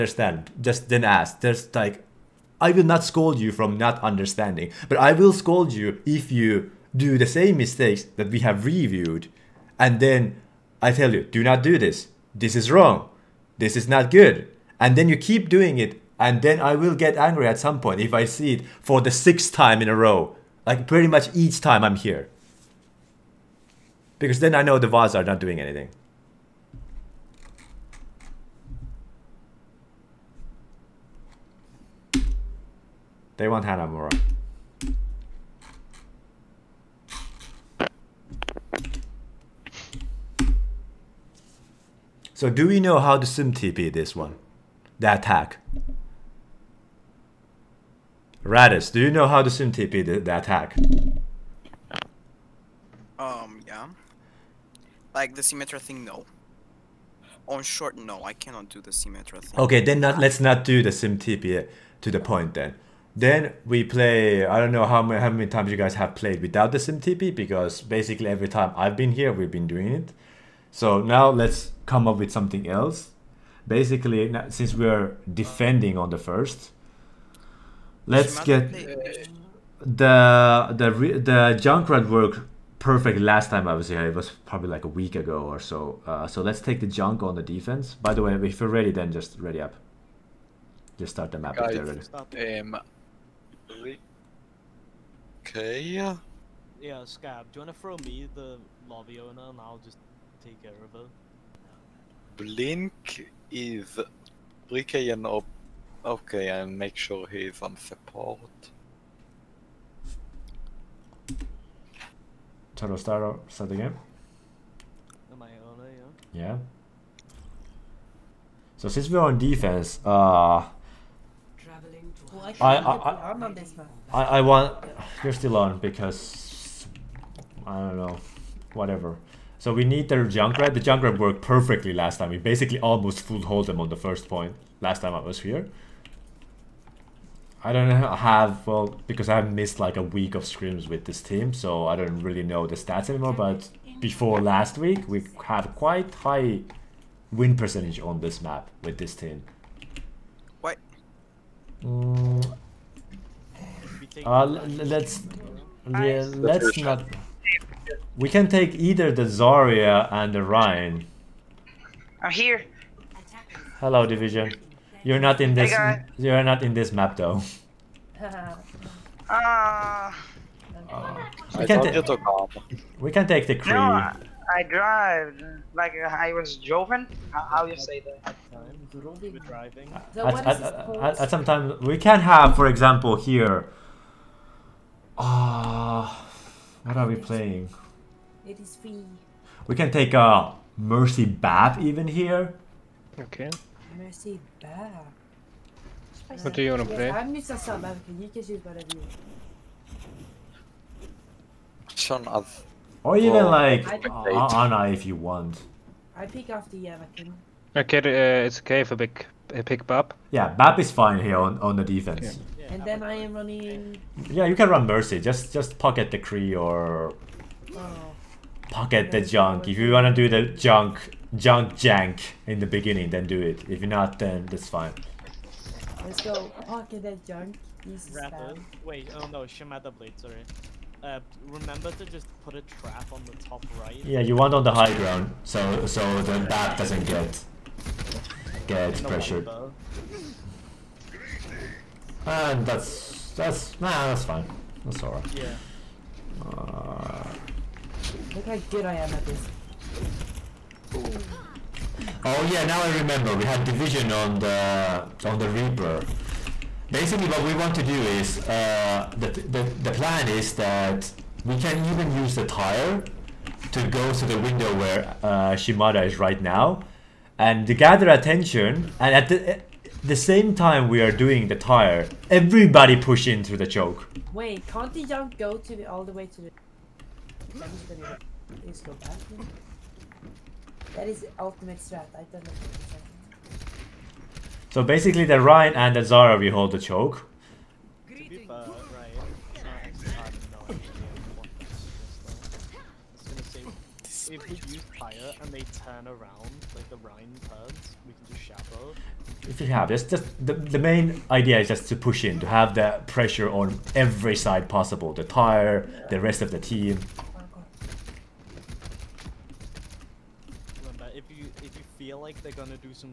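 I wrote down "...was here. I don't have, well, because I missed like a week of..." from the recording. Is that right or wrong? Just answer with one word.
right.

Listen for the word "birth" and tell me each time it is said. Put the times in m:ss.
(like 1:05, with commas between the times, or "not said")
not said.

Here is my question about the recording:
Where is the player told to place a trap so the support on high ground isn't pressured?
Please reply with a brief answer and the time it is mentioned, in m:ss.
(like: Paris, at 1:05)
Top right, at 3:53.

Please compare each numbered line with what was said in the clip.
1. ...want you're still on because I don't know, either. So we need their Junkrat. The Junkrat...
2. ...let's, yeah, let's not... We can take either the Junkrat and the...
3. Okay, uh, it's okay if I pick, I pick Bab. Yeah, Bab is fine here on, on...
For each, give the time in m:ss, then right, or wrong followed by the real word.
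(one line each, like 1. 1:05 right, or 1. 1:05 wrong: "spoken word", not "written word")
1. 2:04 wrong: "whatever", not "either"
2. 2:34 wrong: "Zarya", not "Junkrat"
3. 3:27 right.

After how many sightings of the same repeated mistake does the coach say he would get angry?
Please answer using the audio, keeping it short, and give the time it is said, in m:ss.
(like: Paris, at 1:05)
6, at 0:19.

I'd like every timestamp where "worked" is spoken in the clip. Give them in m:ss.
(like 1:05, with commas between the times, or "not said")
1:22, 2:11.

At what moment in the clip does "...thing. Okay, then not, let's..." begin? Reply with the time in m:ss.
0:59.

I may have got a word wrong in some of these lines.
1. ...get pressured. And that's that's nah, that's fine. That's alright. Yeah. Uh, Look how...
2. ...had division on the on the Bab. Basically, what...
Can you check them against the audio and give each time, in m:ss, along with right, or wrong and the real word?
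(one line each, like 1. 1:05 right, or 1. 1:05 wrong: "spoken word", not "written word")
1. 3:58 right
2. 4:13 wrong: "Reaper", not "Bab".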